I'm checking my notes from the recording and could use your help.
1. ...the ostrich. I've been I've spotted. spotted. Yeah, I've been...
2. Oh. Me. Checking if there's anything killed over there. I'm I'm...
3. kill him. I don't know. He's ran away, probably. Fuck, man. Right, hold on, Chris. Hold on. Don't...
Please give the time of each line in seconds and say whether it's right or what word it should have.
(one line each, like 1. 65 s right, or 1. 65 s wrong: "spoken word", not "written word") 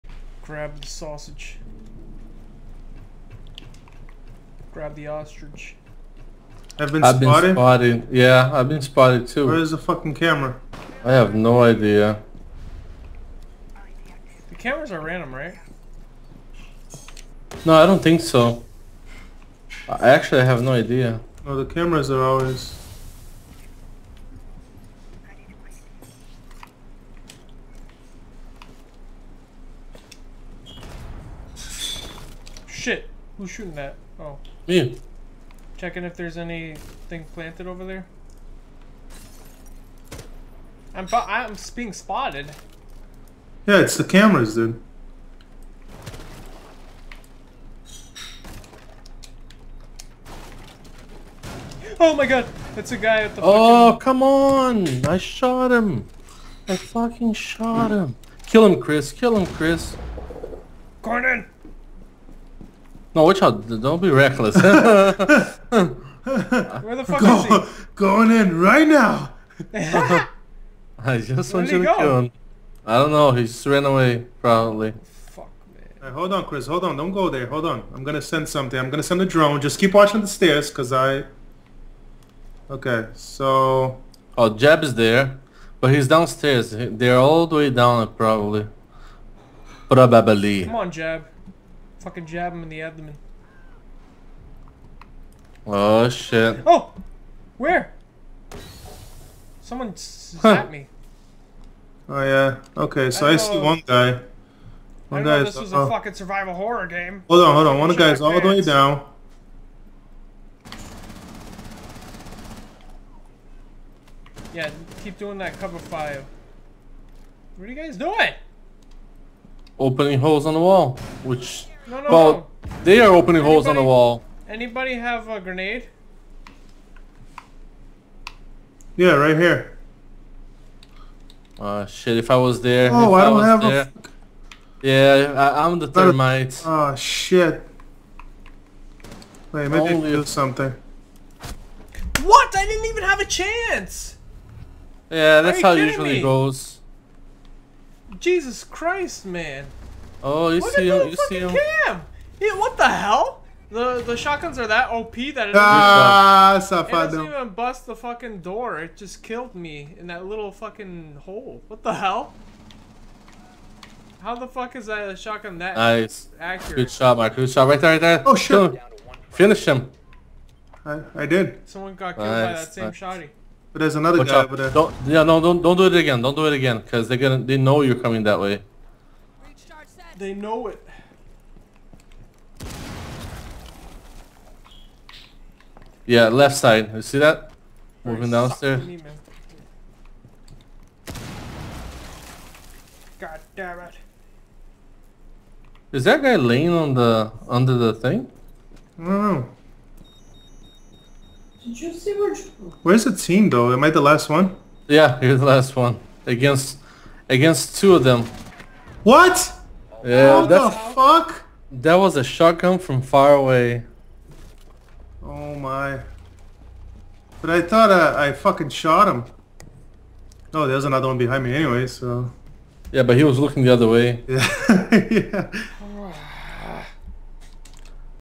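1. 4 s right
2. 34 s wrong: "planted", not "killed"
3. 71 s right.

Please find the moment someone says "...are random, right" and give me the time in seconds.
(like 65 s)
14 s.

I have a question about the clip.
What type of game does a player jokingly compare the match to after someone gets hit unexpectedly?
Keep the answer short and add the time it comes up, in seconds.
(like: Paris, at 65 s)
Survival horror, at 106 s.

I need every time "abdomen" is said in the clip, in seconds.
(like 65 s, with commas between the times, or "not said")
92 s.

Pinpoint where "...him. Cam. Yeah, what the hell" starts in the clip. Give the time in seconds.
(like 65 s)
151 s.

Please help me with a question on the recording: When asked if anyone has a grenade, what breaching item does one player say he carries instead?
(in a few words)
Thermite.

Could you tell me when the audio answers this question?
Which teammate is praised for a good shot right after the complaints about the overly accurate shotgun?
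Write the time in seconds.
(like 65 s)
167 s.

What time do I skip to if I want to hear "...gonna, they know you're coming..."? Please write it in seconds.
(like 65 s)
177 s.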